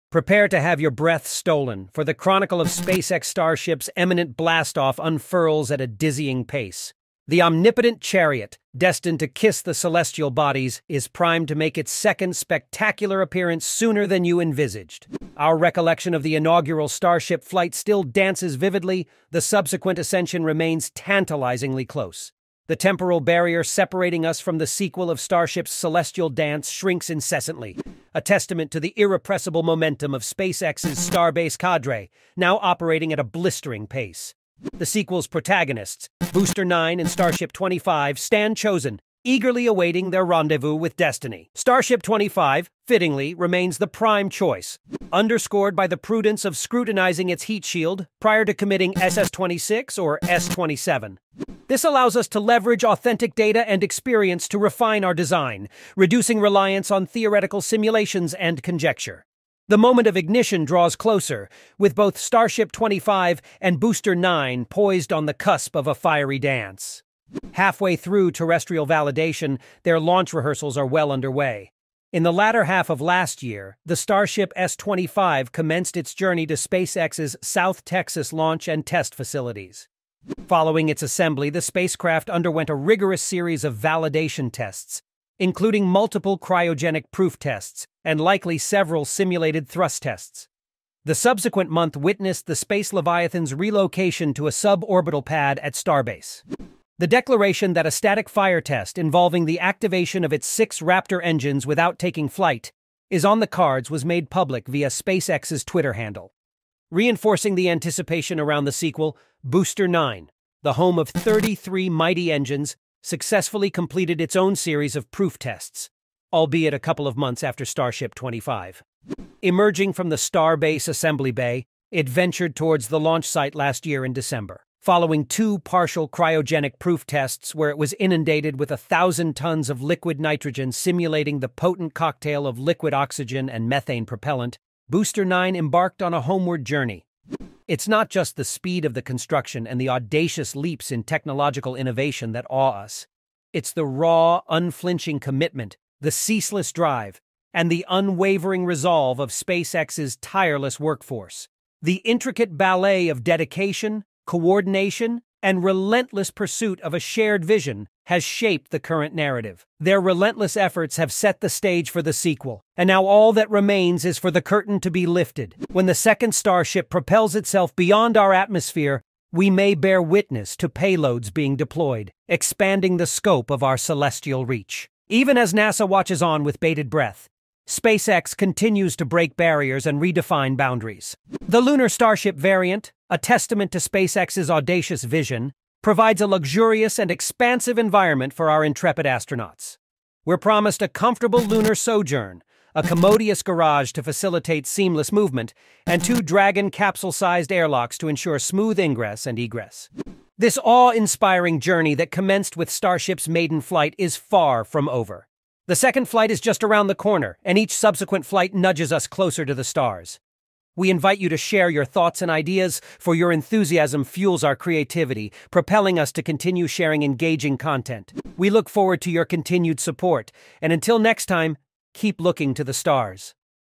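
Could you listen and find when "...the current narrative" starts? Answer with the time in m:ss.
2:38.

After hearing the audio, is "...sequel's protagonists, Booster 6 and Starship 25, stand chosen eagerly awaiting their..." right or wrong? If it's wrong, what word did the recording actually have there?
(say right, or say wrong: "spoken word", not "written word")
wrong: "9", not "6".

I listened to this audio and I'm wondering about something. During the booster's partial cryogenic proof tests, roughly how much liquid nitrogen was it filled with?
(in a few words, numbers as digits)
1,000 tons.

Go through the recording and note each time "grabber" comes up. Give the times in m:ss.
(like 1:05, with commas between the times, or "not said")
not said.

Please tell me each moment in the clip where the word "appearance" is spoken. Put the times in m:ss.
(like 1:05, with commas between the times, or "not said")
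0:13.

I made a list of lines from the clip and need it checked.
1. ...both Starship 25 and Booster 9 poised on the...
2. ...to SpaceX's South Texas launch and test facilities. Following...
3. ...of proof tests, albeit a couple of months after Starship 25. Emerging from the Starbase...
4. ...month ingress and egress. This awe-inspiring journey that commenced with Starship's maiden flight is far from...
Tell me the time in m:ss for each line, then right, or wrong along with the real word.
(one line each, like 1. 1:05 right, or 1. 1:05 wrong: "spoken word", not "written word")
1. 1:01 right
2. 1:16 right
3. 1:54 right
4. 3:18 wrong: "smooth", not "month".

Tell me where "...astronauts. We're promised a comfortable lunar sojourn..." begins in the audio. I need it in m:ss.
3:09.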